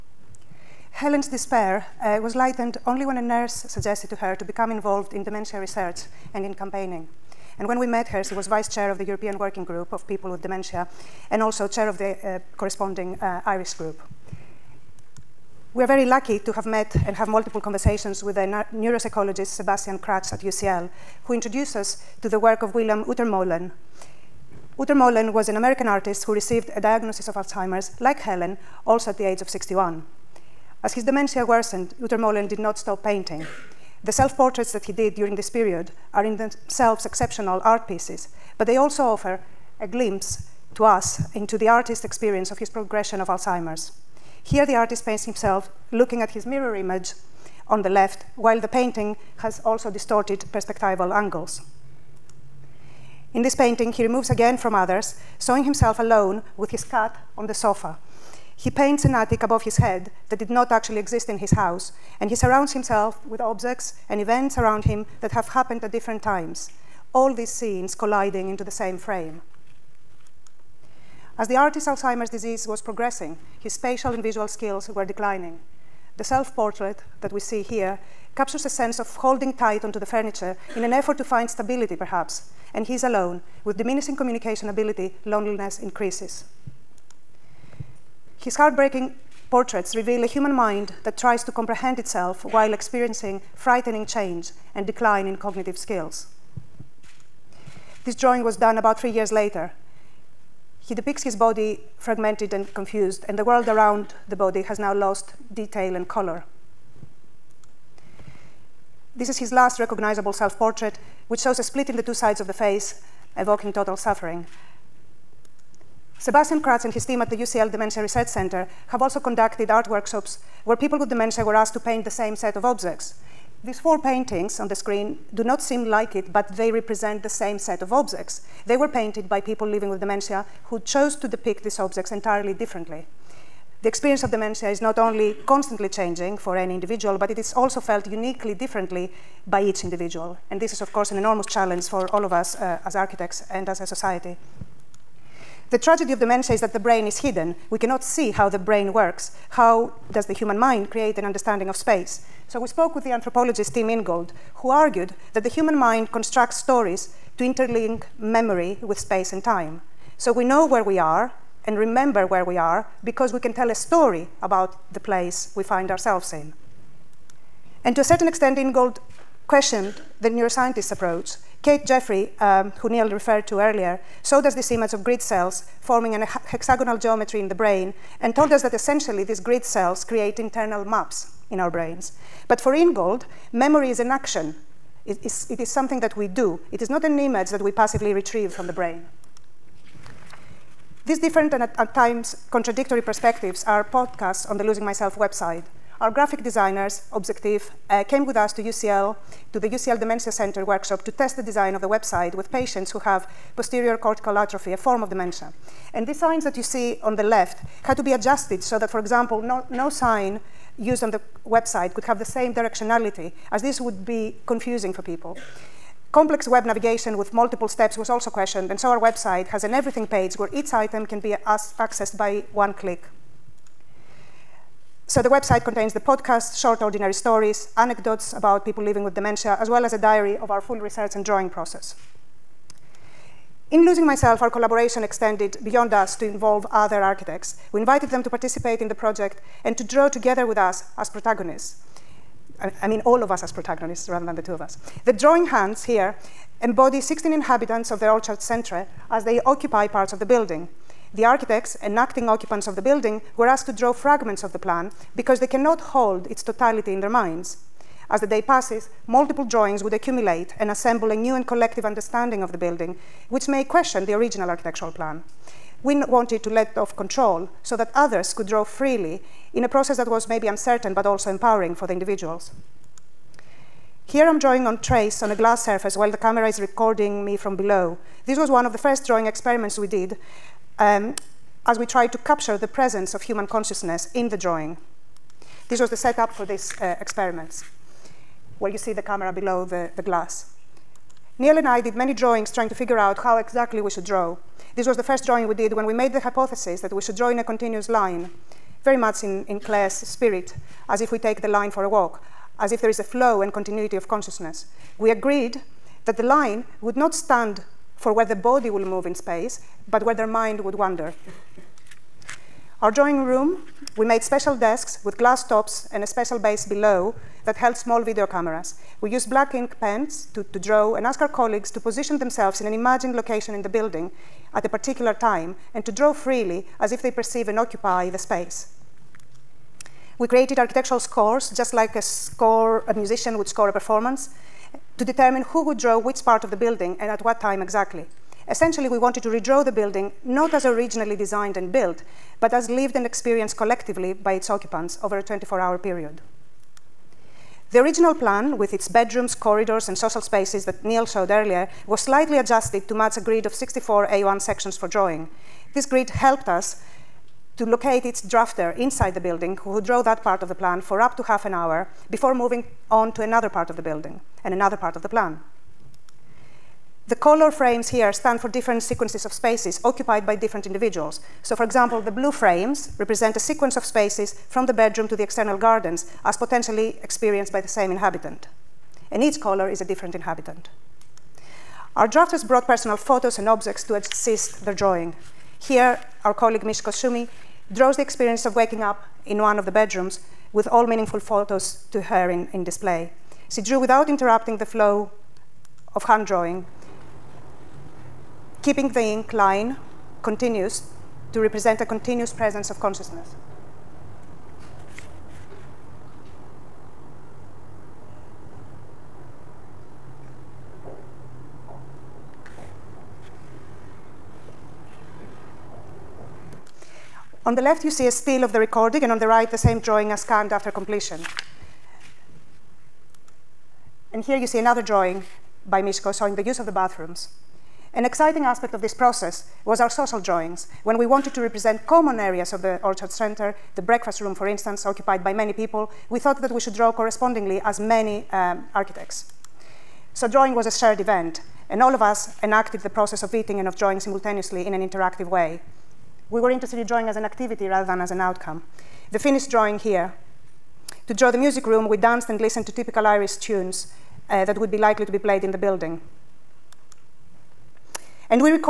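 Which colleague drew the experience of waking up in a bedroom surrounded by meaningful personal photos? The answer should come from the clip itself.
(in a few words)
Mishko Shumi.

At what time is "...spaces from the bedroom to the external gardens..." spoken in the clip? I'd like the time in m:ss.
6:13.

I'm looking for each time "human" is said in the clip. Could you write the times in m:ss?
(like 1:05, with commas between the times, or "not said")
1:30, 2:30, 2:35, 4:43.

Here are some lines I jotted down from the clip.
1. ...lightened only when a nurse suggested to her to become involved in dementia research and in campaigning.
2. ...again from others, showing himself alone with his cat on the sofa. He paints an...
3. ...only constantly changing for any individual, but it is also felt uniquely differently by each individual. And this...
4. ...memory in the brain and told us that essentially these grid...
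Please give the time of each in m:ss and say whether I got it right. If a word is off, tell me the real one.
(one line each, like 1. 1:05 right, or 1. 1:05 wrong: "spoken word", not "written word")
1. 0:02 right
2. 0:54 right
3. 2:14 right
4. 2:56 wrong: "geometry", not "memory".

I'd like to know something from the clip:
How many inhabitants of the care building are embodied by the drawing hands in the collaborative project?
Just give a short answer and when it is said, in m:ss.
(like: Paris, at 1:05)
16, at 4:07.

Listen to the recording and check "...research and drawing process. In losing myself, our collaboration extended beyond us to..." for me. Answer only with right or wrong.
right.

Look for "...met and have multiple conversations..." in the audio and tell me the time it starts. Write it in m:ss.
0:16.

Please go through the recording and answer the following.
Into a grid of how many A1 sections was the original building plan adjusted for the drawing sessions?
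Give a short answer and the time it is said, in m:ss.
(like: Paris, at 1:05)
64, at 5:53.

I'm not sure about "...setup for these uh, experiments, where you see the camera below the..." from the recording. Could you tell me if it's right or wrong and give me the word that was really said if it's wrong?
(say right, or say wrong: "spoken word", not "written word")
right.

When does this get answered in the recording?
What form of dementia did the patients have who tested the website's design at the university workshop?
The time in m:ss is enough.
3:23.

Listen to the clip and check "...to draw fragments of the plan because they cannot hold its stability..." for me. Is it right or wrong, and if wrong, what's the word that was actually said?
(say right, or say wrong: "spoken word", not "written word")
wrong: "totality", not "stability".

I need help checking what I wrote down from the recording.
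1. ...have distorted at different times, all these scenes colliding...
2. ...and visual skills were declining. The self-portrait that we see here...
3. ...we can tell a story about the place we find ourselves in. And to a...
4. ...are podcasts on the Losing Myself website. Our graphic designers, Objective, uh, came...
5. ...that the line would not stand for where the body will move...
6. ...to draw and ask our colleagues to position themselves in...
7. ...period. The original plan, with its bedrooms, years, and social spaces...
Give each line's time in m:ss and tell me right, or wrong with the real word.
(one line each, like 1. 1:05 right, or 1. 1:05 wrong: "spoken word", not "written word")
1. 1:05 wrong: "happened", not "distorted"
2. 1:14 right
3. 2:43 right
4. 3:13 right
5. 5:06 right
6. 5:20 right
7. 5:45 wrong: "corridors", not "years".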